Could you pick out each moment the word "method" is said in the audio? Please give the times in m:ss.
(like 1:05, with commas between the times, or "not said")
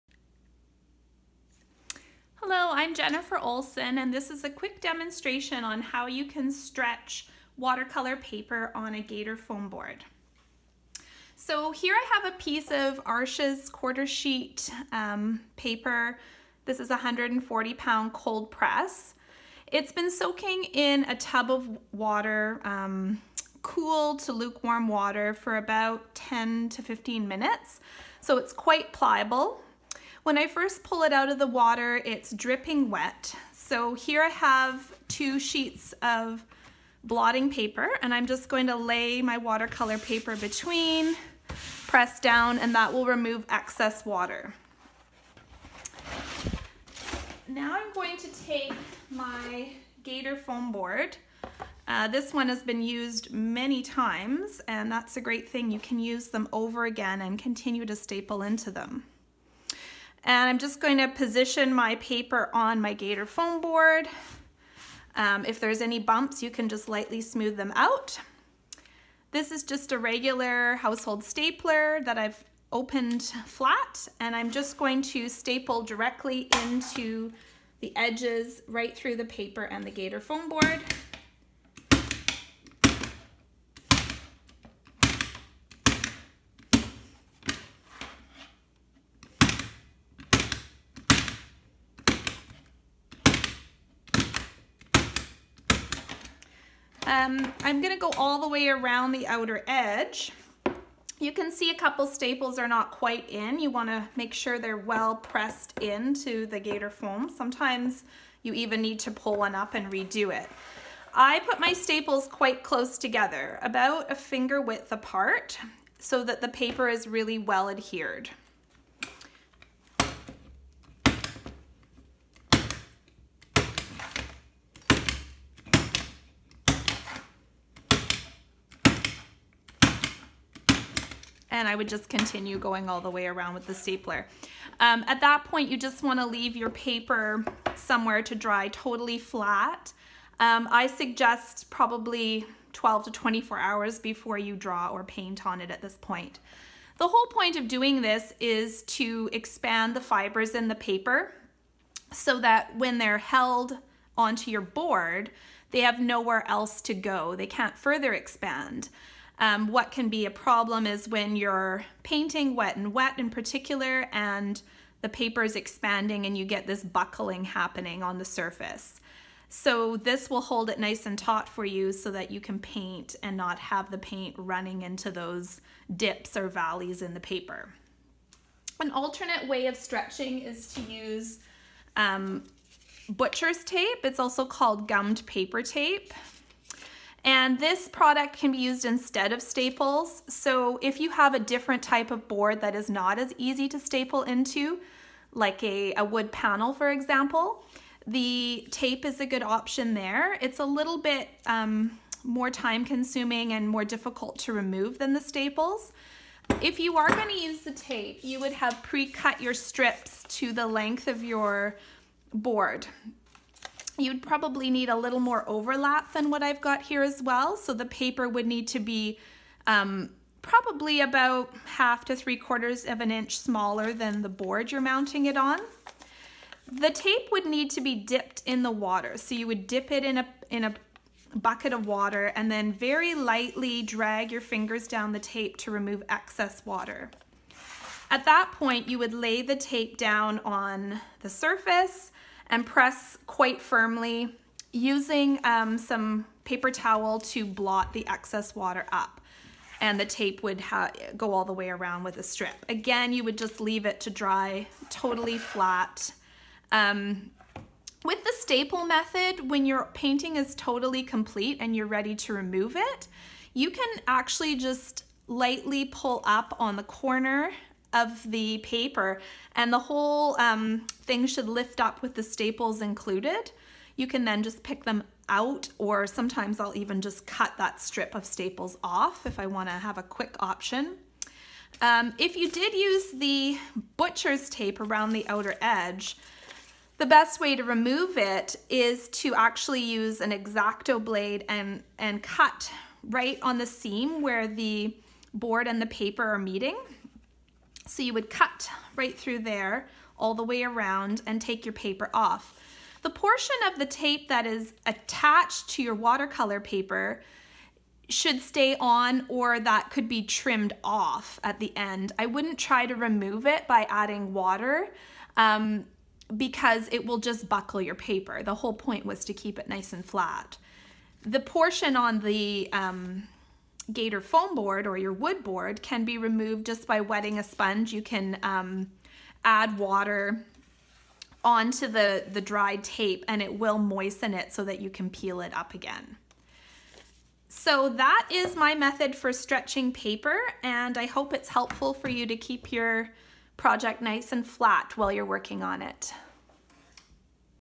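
4:18, 5:38.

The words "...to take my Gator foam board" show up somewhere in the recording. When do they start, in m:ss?
0:48.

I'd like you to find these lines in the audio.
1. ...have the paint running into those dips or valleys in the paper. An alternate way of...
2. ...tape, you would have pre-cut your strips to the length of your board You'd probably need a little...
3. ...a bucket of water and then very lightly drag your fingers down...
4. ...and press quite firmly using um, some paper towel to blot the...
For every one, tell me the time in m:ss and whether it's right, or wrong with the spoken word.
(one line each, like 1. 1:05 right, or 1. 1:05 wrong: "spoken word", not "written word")
1. 2:53 right
2. 3:27 right
3. 3:50 right
4. 4:02 right.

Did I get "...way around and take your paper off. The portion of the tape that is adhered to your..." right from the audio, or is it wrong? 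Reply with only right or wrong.
wrong.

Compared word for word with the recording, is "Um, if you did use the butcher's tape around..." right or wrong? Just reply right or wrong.
right.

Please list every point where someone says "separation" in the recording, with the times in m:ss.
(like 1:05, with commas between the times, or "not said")
not said.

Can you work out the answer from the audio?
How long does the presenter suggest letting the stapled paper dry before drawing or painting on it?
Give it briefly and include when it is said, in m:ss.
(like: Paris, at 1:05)
12 to 24 hours, at 2:22.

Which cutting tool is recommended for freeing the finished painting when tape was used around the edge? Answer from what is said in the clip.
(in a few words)
X-Acto blade.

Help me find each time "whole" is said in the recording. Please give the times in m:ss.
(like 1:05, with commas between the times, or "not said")
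2:27, 4:29, 5:18.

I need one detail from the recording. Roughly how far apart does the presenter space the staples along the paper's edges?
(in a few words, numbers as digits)
a finger width.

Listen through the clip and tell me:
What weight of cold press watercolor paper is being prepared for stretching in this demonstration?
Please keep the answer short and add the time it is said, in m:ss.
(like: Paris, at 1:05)
140 pound, at 0:16.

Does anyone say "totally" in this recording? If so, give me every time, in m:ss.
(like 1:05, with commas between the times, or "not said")
2:18, 4:14, 4:20.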